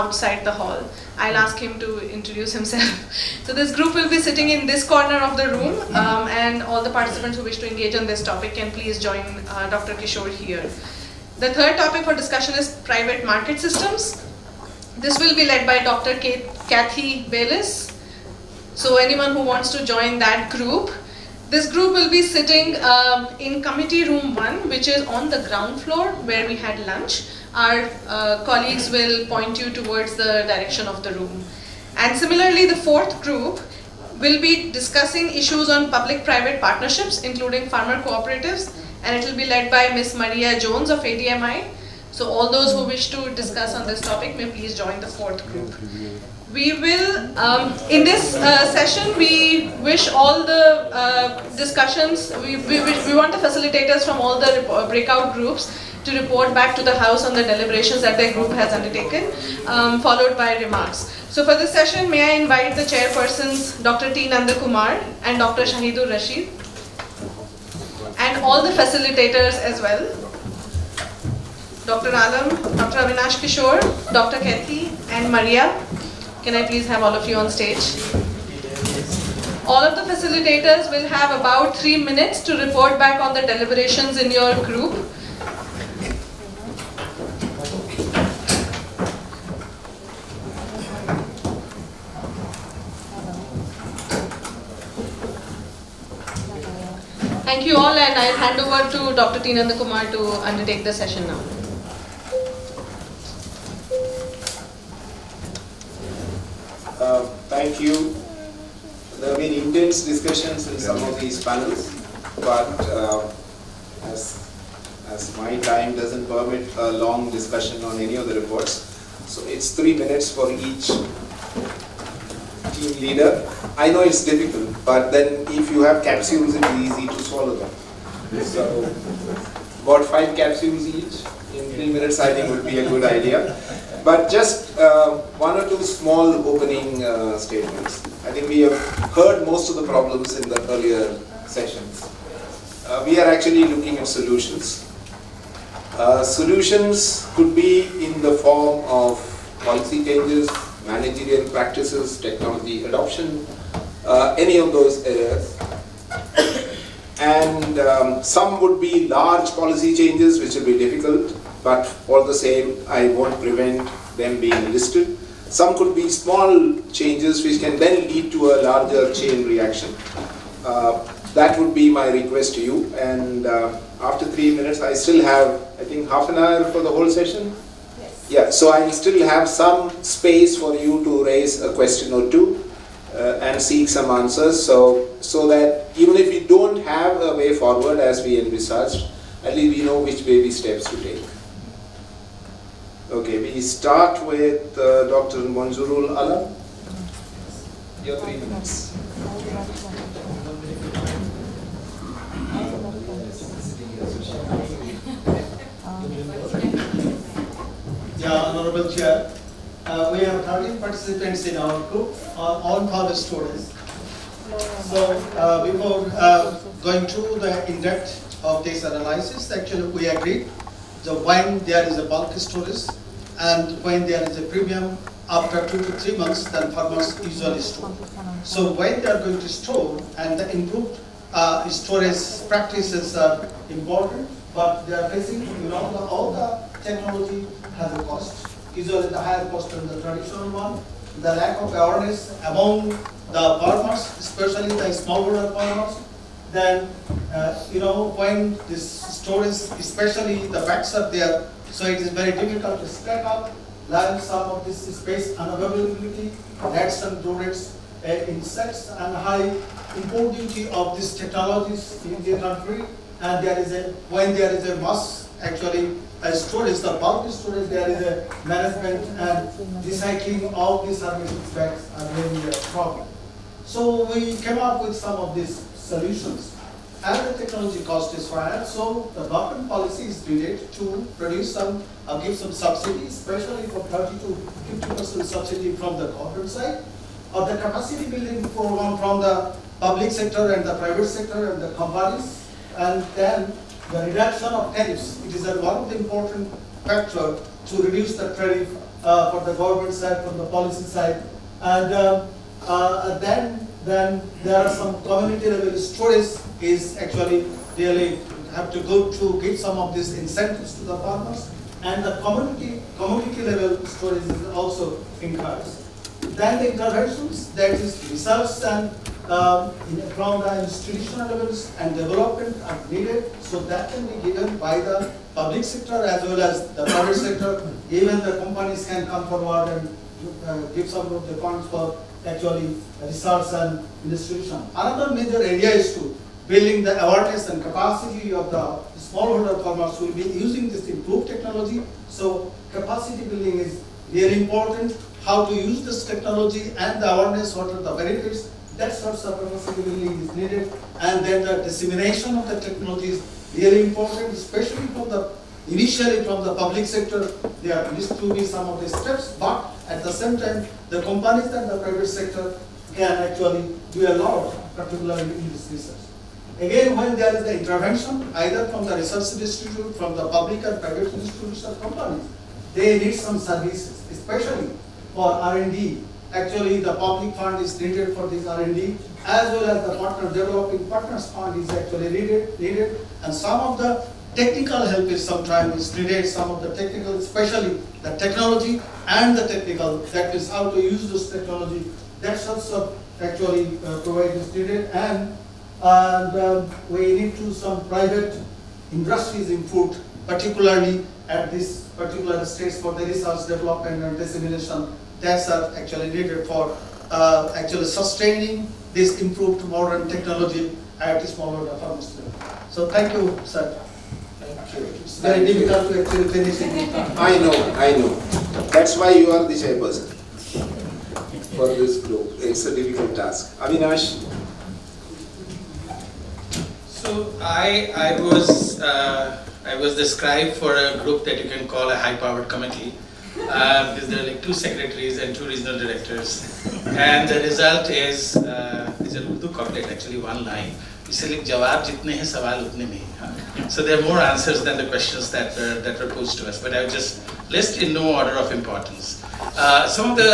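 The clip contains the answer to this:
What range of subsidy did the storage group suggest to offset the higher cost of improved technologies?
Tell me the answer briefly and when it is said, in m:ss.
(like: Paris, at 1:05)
30 to 50%, at 4:43.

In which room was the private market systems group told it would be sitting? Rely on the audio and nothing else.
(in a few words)
Committee room 1.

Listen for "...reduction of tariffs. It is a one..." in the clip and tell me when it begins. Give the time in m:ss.
4:54.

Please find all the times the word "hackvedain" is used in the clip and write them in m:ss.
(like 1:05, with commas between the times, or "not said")
not said.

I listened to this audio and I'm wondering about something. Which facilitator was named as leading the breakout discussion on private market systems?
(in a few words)
Dr. Kathy Baylis.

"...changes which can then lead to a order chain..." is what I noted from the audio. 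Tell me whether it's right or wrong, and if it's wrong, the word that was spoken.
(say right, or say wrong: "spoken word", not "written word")
wrong: "larger", not "order".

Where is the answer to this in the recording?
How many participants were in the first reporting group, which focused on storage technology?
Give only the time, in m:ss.
3:30.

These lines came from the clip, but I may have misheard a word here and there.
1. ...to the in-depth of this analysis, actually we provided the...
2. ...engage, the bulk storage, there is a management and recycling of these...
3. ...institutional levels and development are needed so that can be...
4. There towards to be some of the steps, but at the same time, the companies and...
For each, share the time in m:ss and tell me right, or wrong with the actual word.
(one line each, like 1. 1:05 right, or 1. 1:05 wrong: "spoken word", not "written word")
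1. 3:37 wrong: "agreed", not "provided"
2. 4:26 wrong: "storage", not "engage"
3. 5:20 right
4. 5:57 wrong: "needs", not "towards".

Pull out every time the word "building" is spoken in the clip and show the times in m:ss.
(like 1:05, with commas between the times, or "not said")
4:48, 5:36, 5:43.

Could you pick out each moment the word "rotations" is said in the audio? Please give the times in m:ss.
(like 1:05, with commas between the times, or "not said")
not said.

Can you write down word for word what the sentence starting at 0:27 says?
Our uh, colleagues will point you towards the direction of the room.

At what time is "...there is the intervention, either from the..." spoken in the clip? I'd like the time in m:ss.
6:07.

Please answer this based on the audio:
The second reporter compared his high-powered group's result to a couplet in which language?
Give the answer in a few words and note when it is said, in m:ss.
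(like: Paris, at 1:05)
Urdu, at 7:19.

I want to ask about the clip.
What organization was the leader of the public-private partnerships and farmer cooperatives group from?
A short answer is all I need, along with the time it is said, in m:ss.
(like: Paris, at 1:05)
ADMI, at 0:40.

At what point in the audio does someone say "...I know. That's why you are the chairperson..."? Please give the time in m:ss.
6:57.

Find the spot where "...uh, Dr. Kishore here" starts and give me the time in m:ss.
0:09.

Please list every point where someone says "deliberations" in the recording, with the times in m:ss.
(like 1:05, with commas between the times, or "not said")
0:57, 1:23.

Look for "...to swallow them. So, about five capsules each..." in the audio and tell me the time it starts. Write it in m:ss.
2:07.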